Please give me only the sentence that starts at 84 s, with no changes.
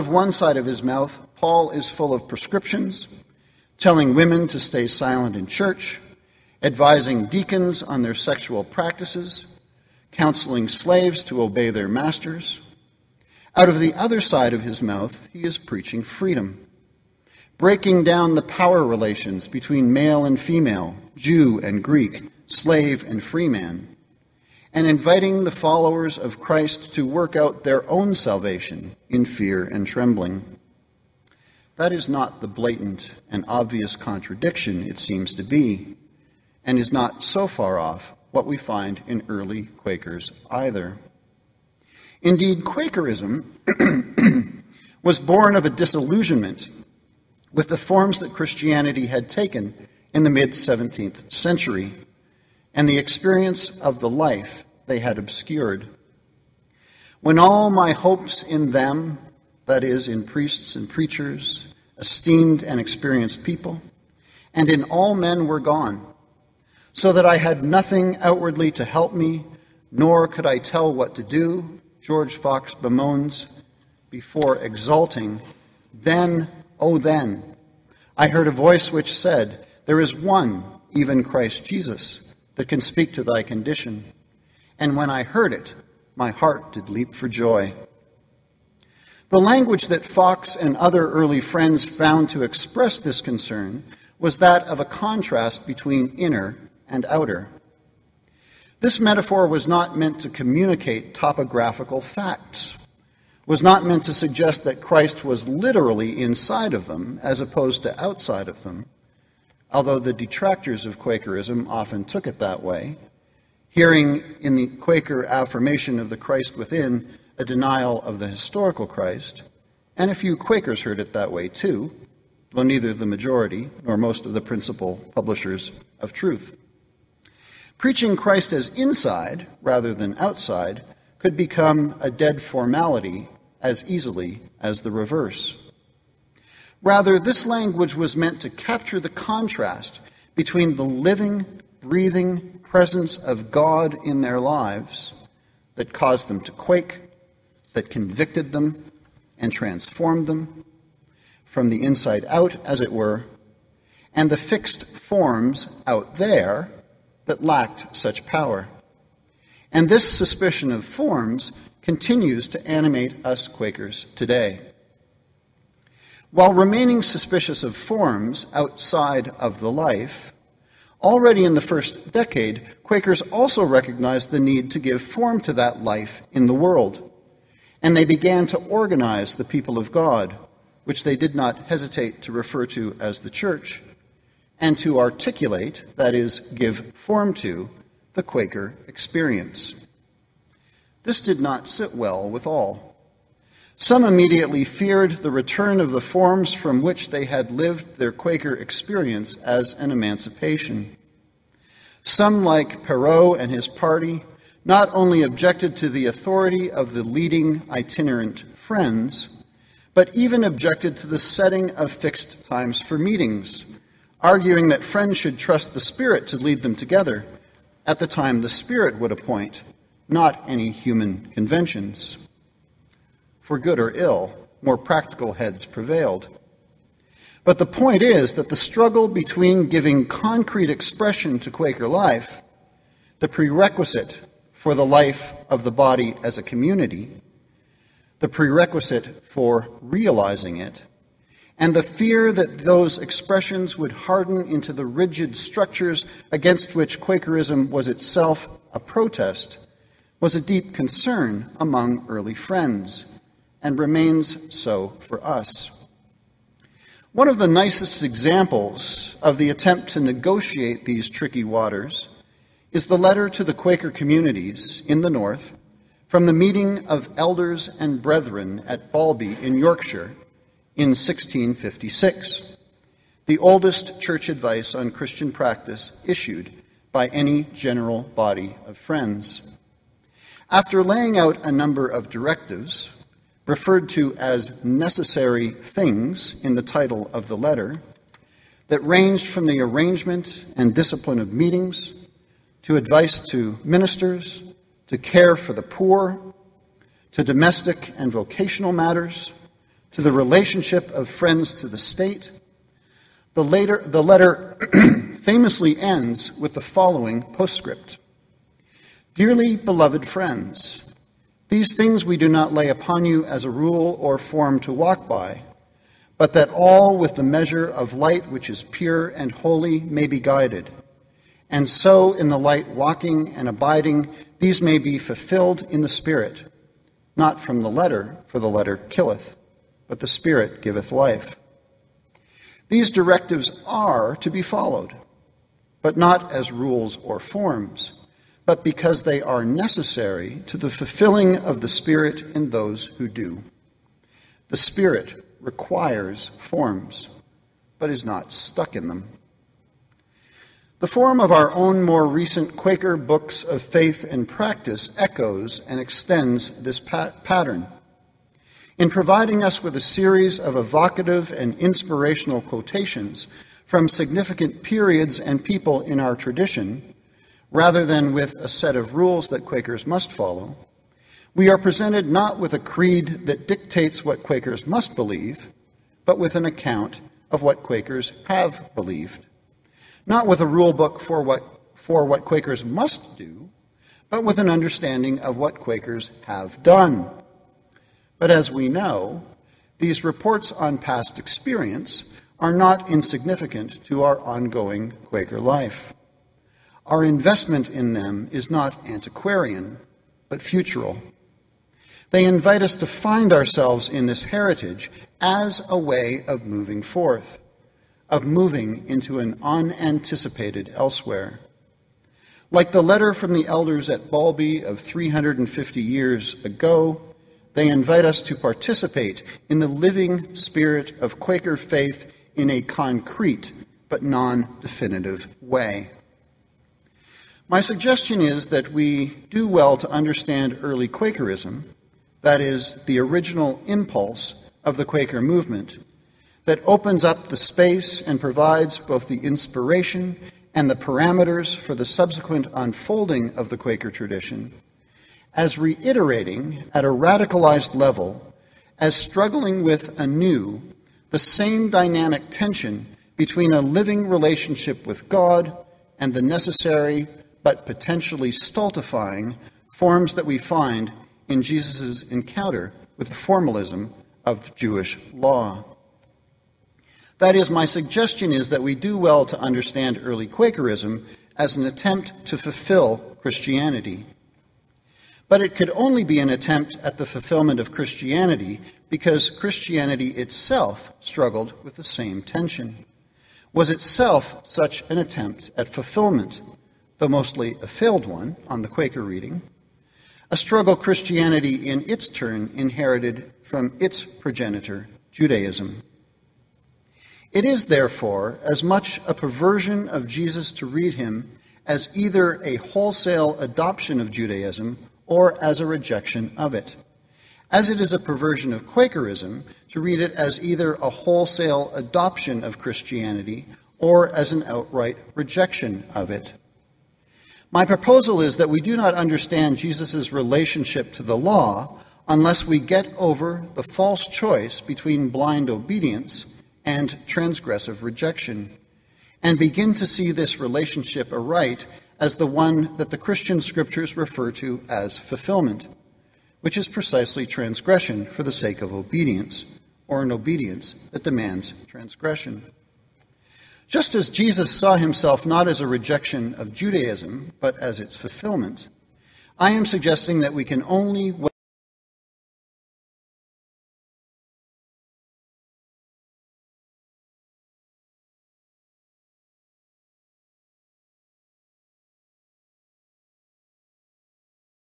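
And when I heard it, my heart did leap for joy.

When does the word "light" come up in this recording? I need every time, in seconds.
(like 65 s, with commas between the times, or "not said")
317 s, 322 s.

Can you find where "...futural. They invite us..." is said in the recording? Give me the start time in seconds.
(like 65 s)
400 s.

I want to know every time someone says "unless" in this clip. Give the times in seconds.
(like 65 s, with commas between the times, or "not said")
522 s.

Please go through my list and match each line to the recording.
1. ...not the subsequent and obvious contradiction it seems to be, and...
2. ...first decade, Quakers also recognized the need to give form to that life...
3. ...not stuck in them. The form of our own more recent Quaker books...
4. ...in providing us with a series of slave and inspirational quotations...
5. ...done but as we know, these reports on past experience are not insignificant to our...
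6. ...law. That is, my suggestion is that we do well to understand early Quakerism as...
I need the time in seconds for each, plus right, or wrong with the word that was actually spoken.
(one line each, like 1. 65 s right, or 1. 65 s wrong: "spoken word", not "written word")
1. 32 s wrong: "blatant", not "subsequent"
2. 171 s right
3. 348 s right
4. 358 s wrong: "evocative", not "slave"
5. 386 s right
6. 465 s right.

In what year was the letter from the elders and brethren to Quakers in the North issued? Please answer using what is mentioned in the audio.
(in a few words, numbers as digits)
1656.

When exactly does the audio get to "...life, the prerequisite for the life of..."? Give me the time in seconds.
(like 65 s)
231 s.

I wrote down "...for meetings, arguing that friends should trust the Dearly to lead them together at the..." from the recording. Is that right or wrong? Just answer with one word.
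wrong.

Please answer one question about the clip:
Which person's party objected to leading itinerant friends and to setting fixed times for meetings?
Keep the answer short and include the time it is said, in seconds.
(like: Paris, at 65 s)
Perrot, at 202 s.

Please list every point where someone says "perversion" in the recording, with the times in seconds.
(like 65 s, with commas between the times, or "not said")
499 s, 507 s.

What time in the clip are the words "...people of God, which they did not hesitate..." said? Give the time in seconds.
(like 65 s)
179 s.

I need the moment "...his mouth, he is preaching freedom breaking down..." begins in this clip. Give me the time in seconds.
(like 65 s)
14 s.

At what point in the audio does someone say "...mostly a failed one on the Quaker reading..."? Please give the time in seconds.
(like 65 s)
487 s.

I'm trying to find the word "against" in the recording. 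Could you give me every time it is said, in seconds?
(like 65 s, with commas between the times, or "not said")
246 s.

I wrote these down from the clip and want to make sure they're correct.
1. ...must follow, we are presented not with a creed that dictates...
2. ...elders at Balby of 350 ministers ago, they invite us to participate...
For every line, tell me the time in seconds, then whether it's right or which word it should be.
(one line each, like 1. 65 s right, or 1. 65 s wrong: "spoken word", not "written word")
1. 369 s right
2. 413 s wrong: "years", not "ministers".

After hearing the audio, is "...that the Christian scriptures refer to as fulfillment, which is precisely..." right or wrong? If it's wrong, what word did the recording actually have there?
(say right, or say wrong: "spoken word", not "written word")
right.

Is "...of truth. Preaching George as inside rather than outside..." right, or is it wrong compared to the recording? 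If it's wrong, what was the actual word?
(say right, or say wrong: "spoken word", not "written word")
wrong: "Christ", not "George".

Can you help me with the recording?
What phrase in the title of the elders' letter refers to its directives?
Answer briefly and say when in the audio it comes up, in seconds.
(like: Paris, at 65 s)
necessary things, at 284 s.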